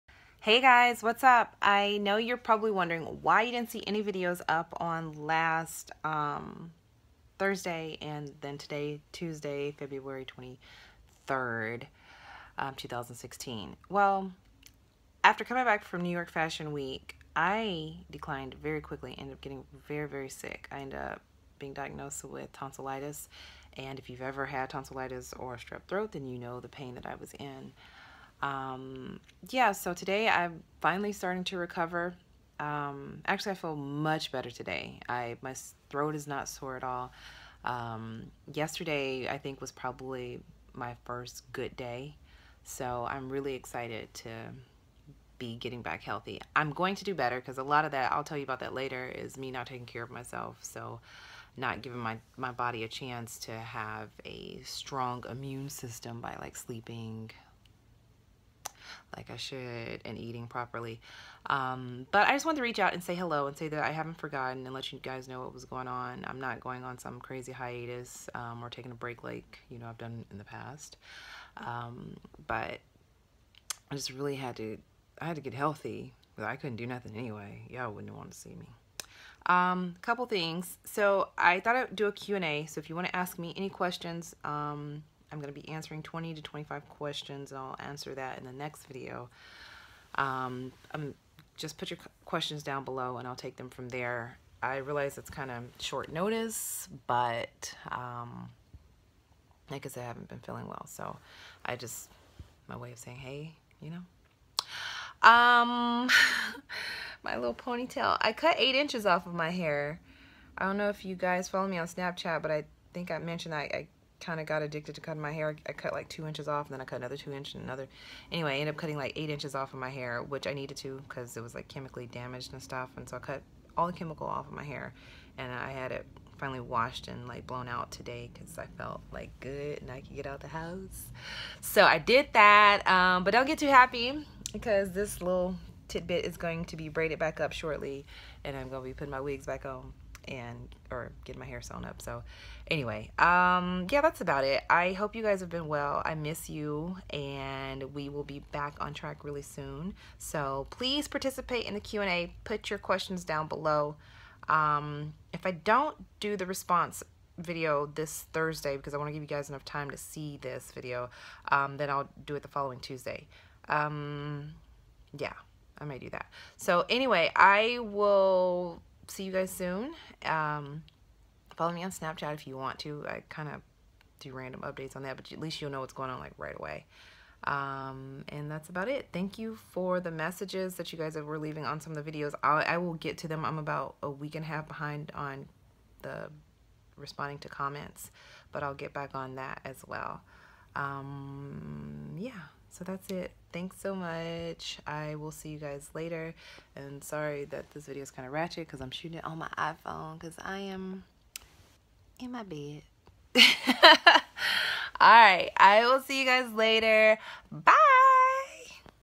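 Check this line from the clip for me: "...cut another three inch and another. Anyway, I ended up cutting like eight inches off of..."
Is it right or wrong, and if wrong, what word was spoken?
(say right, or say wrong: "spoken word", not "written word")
wrong: "two", not "three".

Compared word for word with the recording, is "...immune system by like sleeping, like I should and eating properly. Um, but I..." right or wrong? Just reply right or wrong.
right.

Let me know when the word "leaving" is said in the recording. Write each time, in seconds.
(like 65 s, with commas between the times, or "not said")
181 s.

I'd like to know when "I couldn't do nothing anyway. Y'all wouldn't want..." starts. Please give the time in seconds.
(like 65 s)
76 s.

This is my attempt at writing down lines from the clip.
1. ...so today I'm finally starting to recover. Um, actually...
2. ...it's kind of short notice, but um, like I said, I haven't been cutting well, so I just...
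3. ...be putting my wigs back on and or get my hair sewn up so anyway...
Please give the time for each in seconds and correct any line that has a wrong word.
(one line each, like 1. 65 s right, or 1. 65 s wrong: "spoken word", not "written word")
1. 29 s right
2. 95 s wrong: "feeling", not "cutting"
3. 138 s right.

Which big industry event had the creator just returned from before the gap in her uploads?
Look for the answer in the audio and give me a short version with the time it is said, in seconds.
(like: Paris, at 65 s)
New York Fashion Week, at 16 s.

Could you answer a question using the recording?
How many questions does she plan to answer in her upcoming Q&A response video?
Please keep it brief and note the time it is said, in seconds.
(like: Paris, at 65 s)
20 to 25, at 86 s.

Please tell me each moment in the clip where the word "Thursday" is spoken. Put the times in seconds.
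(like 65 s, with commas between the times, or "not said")
7 s, 158 s.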